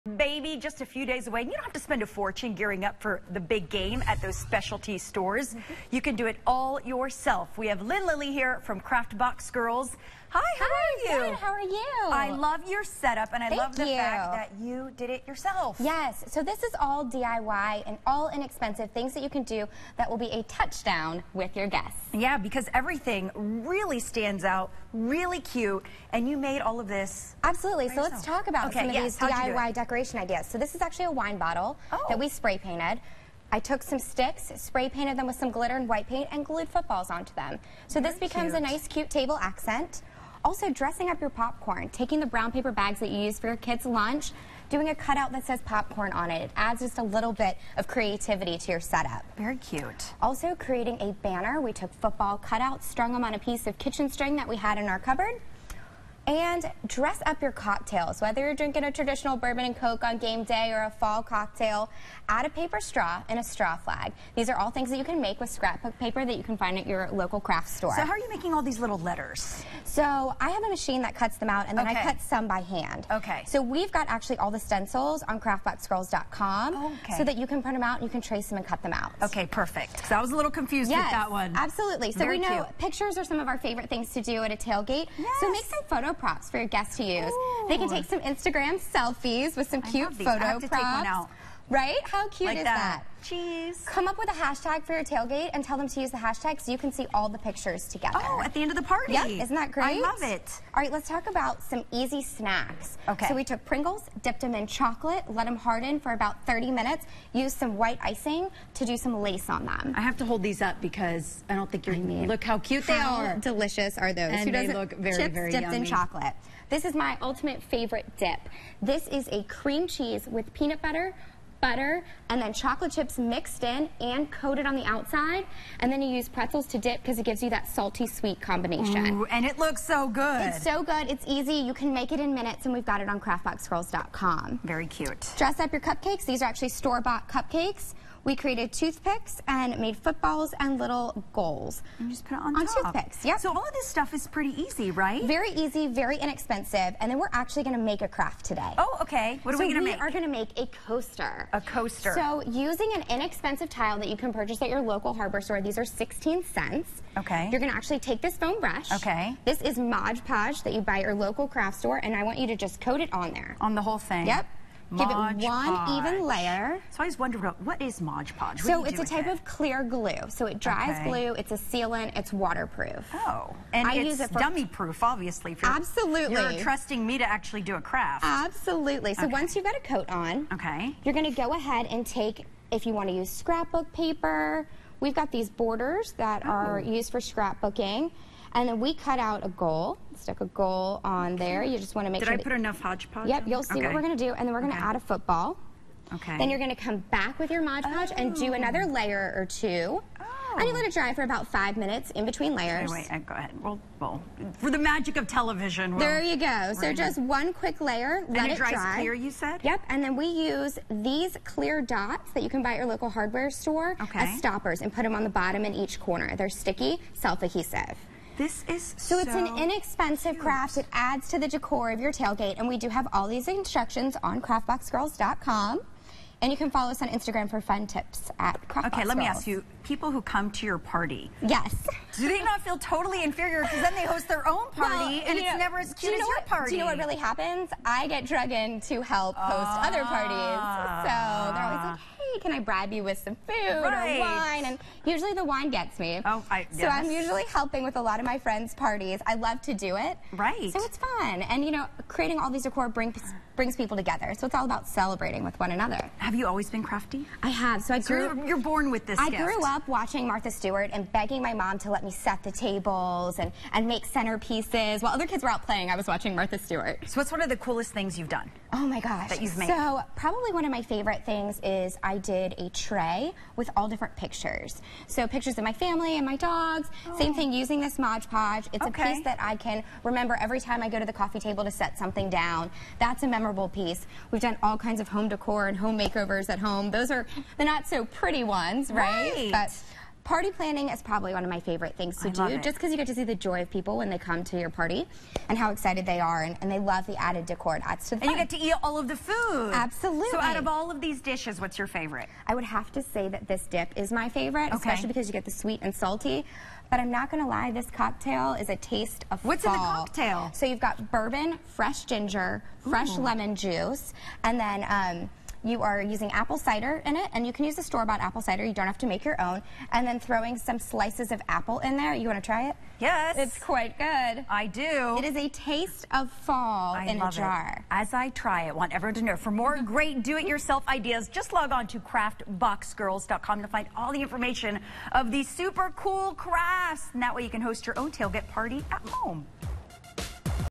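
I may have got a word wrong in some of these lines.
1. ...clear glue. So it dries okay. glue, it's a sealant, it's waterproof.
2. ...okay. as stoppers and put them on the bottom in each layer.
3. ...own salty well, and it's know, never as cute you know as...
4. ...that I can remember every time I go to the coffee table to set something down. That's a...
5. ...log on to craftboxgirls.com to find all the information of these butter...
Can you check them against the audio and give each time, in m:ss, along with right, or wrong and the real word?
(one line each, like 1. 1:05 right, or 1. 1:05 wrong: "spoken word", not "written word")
1. 2:49 right
2. 3:34 wrong: "corner", not "layer"
3. 3:54 wrong: "party", not "salty"
4. 4:39 right
5. 5:31 wrong: "super", not "butter".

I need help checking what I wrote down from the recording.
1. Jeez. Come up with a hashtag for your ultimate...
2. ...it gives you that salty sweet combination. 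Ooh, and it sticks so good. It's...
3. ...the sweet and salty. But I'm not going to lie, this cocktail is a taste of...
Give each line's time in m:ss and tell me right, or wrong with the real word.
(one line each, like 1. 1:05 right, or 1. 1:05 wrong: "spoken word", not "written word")
1. 1:33 wrong: "tailgate", not "ultimate"
2. 2:07 wrong: "looks", not "sticks"
3. 5:05 right.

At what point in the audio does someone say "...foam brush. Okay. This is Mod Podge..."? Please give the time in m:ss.
2:38.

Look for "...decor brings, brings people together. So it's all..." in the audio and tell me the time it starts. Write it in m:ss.
4:12.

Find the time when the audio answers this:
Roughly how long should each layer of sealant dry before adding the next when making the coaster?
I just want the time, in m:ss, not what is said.
3:21.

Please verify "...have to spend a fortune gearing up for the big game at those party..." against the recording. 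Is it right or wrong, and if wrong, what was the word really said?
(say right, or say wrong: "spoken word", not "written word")
wrong: "specialty", not "party".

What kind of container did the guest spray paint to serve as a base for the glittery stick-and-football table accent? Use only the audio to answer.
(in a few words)
wine bottle.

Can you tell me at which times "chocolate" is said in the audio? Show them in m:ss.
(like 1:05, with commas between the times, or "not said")
1:44, 1:55, 2:02.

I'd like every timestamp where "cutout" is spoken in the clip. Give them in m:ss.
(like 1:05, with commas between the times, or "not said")
0:44, 0:52.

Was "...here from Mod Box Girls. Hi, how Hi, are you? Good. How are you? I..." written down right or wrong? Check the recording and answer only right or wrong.
wrong.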